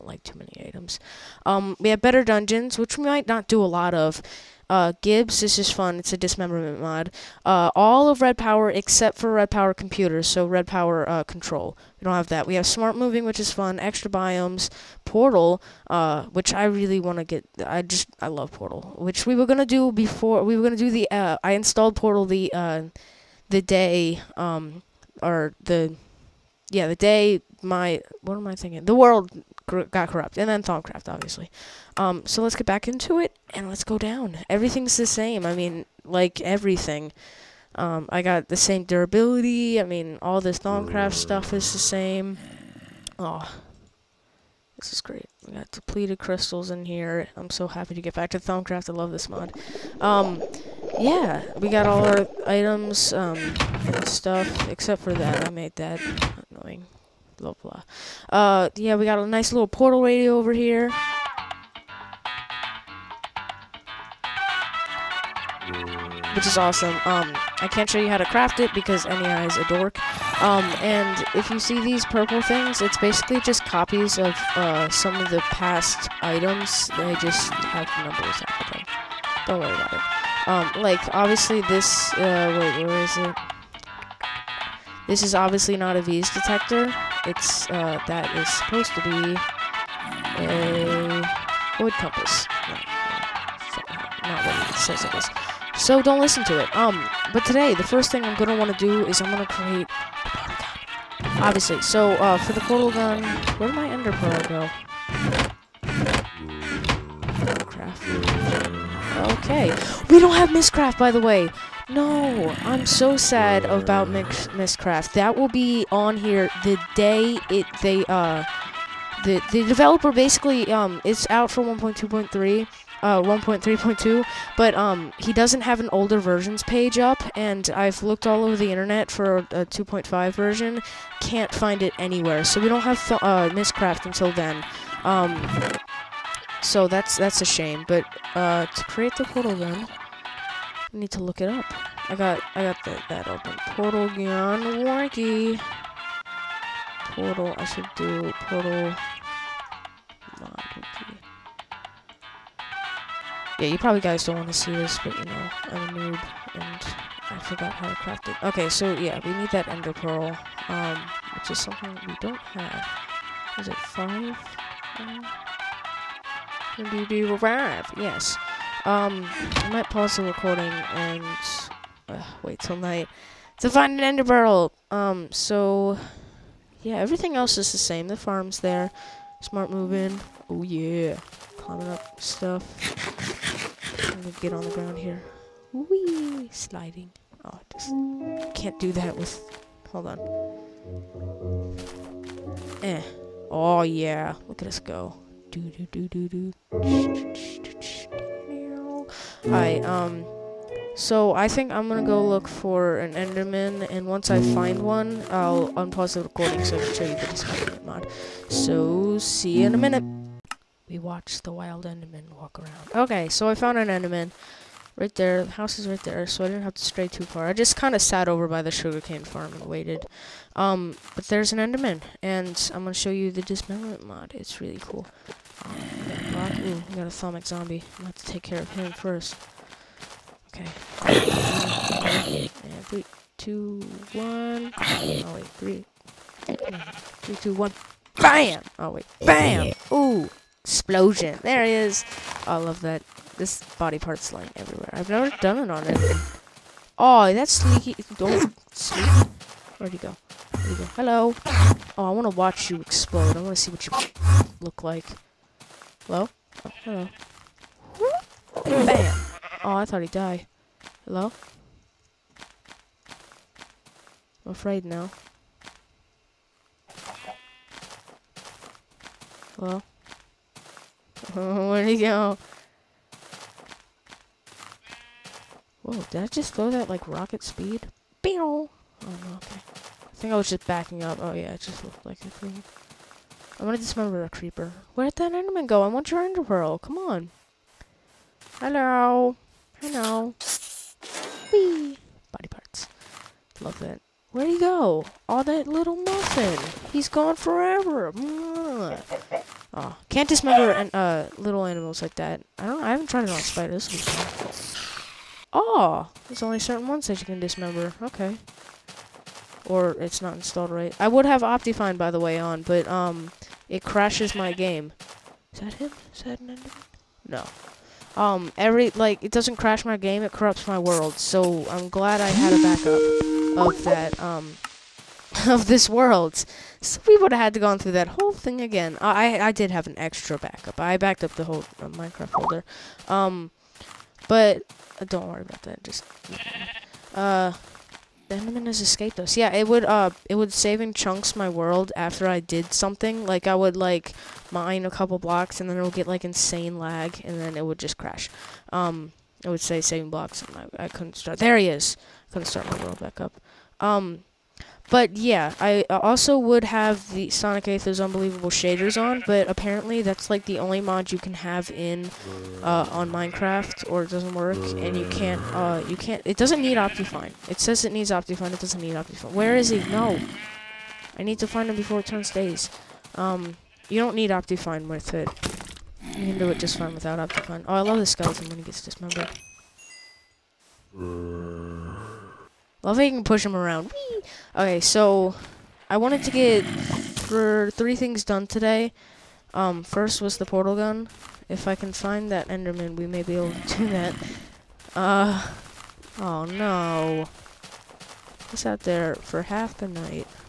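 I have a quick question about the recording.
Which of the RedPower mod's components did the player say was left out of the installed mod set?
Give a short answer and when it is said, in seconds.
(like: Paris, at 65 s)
Red Power Computers, at 9 s.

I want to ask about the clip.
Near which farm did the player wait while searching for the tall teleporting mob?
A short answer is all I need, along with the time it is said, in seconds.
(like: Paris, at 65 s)
sugarcane farm, at 218 s.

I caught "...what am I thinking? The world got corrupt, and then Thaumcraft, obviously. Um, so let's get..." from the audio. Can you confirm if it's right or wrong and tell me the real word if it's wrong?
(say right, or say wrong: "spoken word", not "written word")
right.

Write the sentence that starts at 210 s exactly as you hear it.
We watched the wild Enderman walk around.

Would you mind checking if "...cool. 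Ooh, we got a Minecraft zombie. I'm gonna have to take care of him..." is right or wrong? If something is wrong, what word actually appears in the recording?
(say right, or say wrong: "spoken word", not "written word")
wrong: "Sonic", not "Minecraft".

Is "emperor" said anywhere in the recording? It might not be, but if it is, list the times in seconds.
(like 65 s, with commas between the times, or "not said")
not said.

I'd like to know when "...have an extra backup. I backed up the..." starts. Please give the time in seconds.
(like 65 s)
329 s.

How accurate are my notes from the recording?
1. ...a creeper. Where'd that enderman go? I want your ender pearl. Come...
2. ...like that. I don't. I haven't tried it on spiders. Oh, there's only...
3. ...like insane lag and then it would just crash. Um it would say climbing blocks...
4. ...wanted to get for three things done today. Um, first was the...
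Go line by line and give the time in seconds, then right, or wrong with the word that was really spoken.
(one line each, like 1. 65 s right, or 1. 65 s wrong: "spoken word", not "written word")
1. 284 s right
2. 302 s right
3. 346 s wrong: "saving", not "climbing"
4. 385 s right.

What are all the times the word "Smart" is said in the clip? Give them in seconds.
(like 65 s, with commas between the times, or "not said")
12 s, 179 s.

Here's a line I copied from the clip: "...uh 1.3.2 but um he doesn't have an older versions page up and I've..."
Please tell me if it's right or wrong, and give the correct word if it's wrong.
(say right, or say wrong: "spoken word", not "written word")
right.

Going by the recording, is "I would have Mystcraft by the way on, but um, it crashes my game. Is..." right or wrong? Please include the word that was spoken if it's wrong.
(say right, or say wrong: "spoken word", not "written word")
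wrong: "Optifine", not "Mystcraft".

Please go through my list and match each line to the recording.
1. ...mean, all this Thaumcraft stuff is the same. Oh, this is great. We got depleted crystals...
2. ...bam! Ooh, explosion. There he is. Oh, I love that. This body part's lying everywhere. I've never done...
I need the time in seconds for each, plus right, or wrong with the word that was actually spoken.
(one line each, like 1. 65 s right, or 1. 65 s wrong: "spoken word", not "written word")
1. 39 s right
2. 239 s right.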